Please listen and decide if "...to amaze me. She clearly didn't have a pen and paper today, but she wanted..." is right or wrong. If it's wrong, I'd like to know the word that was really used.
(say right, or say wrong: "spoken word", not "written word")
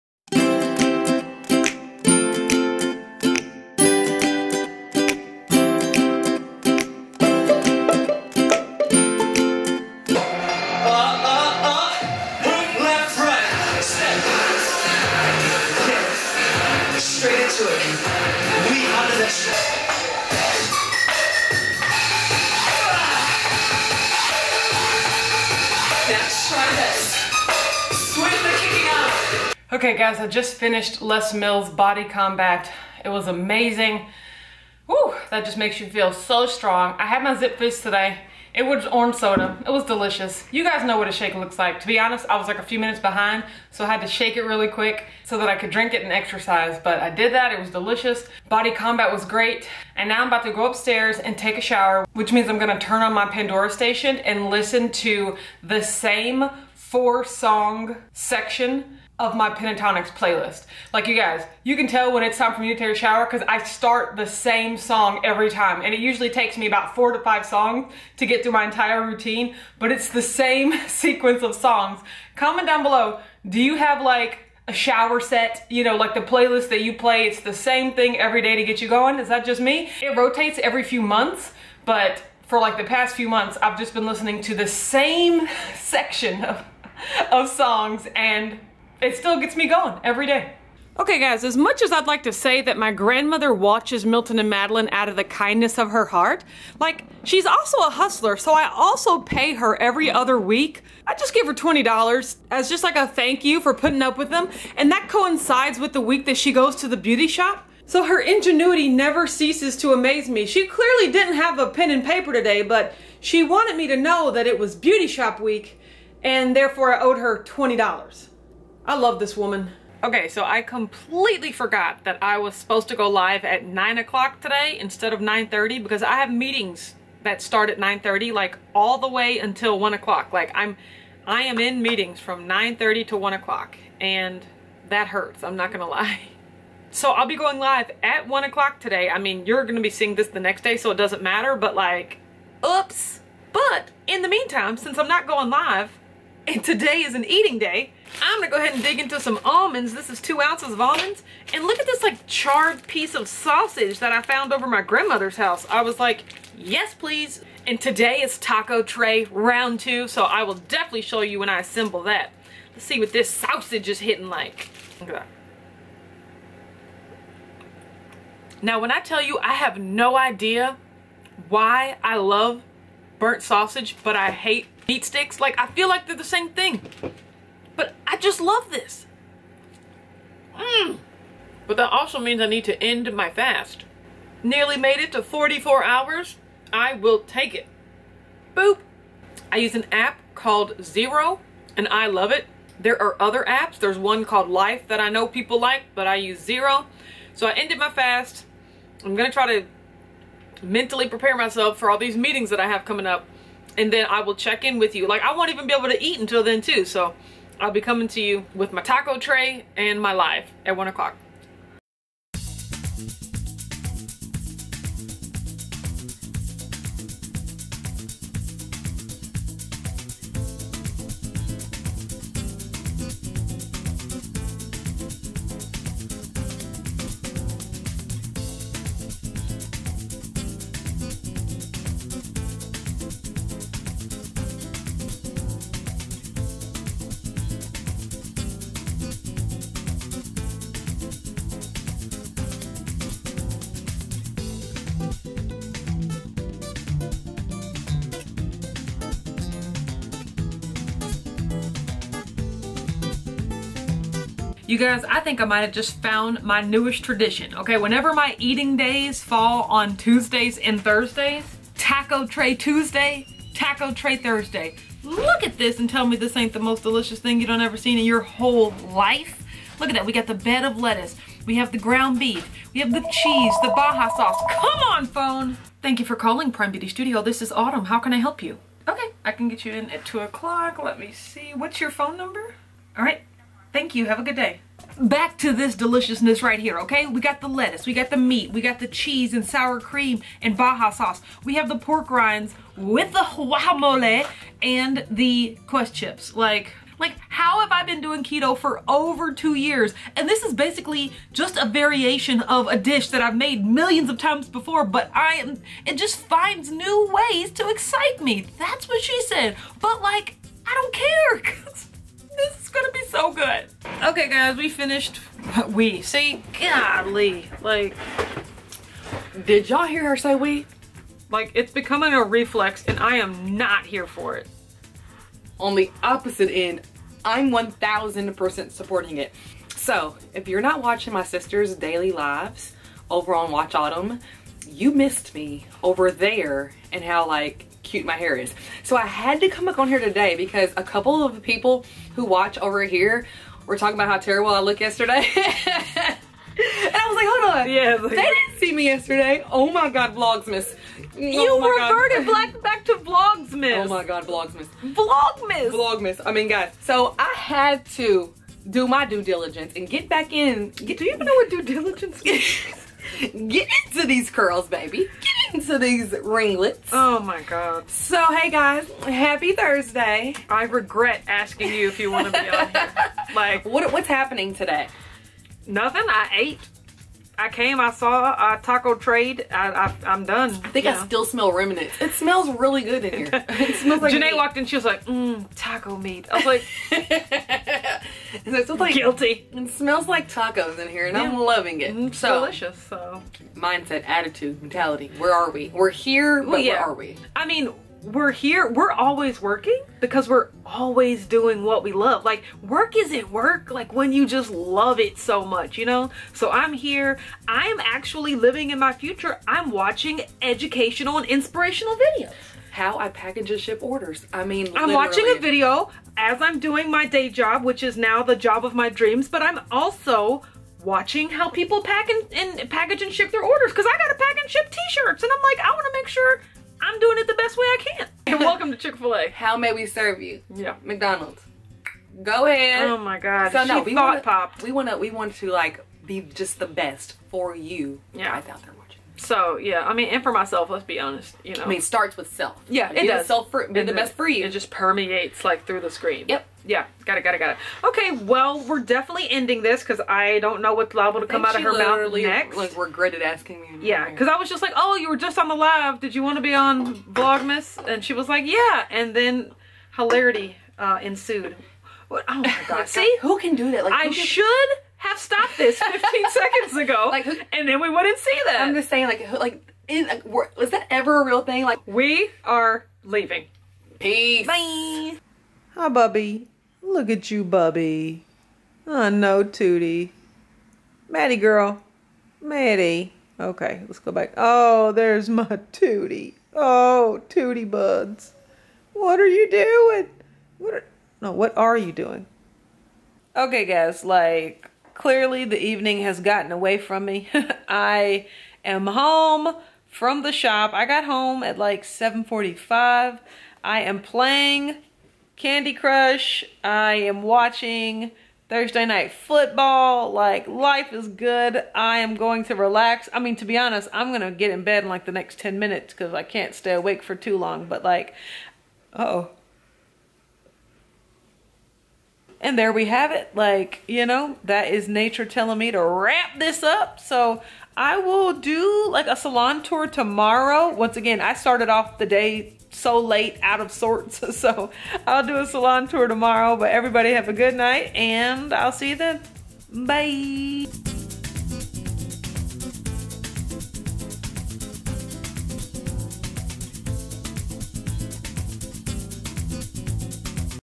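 right.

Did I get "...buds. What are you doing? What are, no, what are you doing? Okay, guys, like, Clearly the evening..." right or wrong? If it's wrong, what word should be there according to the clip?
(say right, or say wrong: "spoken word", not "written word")
right.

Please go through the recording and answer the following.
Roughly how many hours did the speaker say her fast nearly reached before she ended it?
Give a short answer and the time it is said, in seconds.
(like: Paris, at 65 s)
44, at 185 s.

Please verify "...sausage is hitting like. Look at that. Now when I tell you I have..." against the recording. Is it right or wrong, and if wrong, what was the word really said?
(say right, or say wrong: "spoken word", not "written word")
right.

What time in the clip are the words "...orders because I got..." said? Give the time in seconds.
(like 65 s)
423 s.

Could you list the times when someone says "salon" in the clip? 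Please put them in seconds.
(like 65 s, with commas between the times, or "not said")
529 s, 535 s.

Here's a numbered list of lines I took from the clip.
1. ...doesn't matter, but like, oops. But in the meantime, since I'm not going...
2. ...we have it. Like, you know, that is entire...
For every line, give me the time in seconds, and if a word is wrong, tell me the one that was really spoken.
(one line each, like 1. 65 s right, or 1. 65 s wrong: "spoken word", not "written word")
1. 140 s right
2. 522 s wrong: "nature", not "entire".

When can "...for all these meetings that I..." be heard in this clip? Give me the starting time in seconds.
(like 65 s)
201 s.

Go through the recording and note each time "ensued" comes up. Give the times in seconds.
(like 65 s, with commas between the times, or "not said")
461 s.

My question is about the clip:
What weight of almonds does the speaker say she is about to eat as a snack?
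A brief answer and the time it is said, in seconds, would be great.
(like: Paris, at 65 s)
2 ounces, at 150 s.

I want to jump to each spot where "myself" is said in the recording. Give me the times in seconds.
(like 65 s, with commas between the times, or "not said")
201 s, 440 s.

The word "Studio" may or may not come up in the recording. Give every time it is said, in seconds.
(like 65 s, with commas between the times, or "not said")
276 s.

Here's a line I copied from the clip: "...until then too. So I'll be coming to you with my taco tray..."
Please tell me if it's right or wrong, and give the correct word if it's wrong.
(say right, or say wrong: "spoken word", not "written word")
right.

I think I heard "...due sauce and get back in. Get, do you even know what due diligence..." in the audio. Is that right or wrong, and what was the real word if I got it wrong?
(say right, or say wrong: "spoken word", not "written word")
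wrong: "diligence", not "sauce".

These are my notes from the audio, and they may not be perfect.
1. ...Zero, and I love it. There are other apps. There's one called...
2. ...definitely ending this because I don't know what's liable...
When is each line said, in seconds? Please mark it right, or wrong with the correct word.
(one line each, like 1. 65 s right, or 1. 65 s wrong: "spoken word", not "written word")
1. 190 s right
2. 448 s right.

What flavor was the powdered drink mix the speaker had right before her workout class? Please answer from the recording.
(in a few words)
orange soda.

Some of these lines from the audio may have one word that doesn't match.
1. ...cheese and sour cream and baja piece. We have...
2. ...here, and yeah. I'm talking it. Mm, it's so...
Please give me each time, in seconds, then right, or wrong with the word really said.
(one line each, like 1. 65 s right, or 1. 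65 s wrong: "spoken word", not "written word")
1. 288 s wrong: "sauce", not "piece"
2. 390 s wrong: "loving", not "talking".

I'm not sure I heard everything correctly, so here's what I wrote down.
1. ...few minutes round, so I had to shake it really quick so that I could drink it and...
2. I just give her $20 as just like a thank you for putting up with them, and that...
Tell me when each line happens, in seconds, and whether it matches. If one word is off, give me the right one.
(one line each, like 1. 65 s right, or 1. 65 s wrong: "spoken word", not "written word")
1. 42 s wrong: "behind", not "round"
2. 101 s right.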